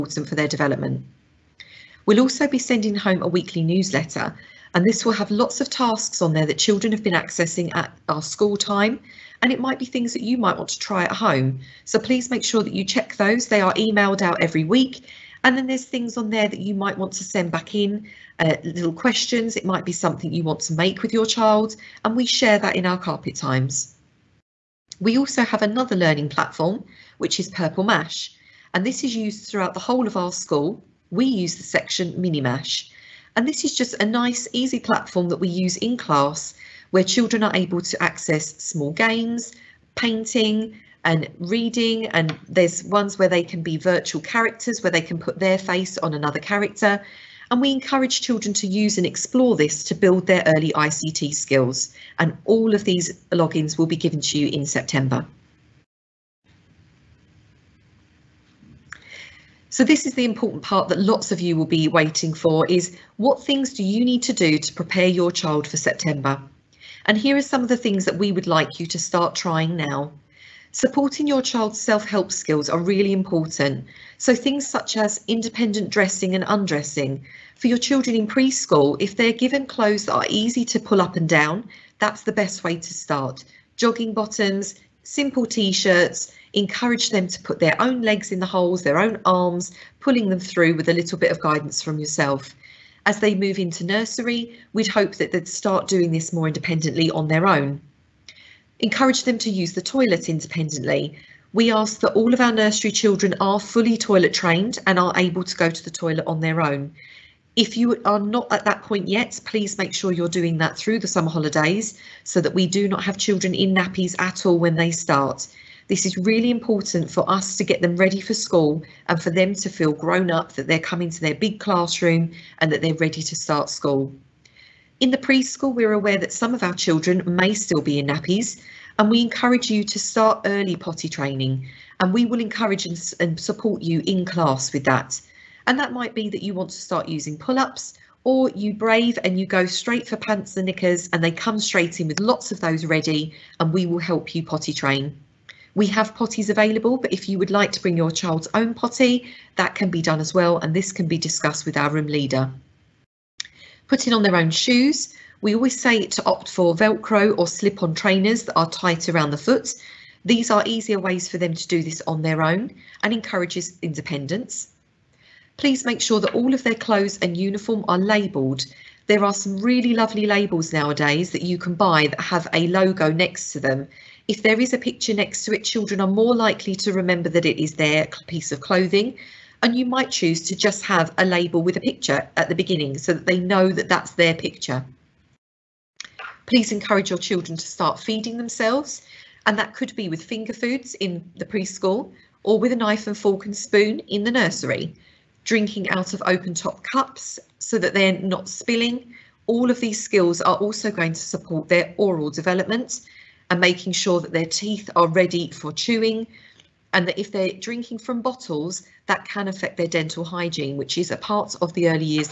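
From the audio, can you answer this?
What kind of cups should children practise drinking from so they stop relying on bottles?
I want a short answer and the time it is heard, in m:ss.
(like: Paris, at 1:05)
Open top cups, at 3:16.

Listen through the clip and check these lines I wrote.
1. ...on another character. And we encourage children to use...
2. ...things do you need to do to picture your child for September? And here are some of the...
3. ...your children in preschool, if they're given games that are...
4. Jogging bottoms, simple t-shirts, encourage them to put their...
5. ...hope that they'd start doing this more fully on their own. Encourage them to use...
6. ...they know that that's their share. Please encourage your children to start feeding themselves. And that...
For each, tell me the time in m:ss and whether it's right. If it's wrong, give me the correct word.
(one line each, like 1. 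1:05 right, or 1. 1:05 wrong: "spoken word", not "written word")
1. 0:45 right
2. 1:03 wrong: "prepare", not "picture"
3. 1:17 wrong: "clothes", not "games"
4. 1:23 right
5. 1:34 wrong: "independently", not "fully"
6. 3:03 wrong: "picture", not "share".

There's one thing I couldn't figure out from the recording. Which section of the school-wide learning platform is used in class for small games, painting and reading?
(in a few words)
Mini Mash.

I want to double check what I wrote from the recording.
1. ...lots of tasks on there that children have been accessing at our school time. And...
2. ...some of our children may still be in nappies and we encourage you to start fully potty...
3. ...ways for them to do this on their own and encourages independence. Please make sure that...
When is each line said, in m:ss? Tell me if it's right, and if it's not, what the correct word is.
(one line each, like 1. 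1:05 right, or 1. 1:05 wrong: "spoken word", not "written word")
1. 0:05 right
2. 2:06 wrong: "early", not "fully"
3. 2:40 right.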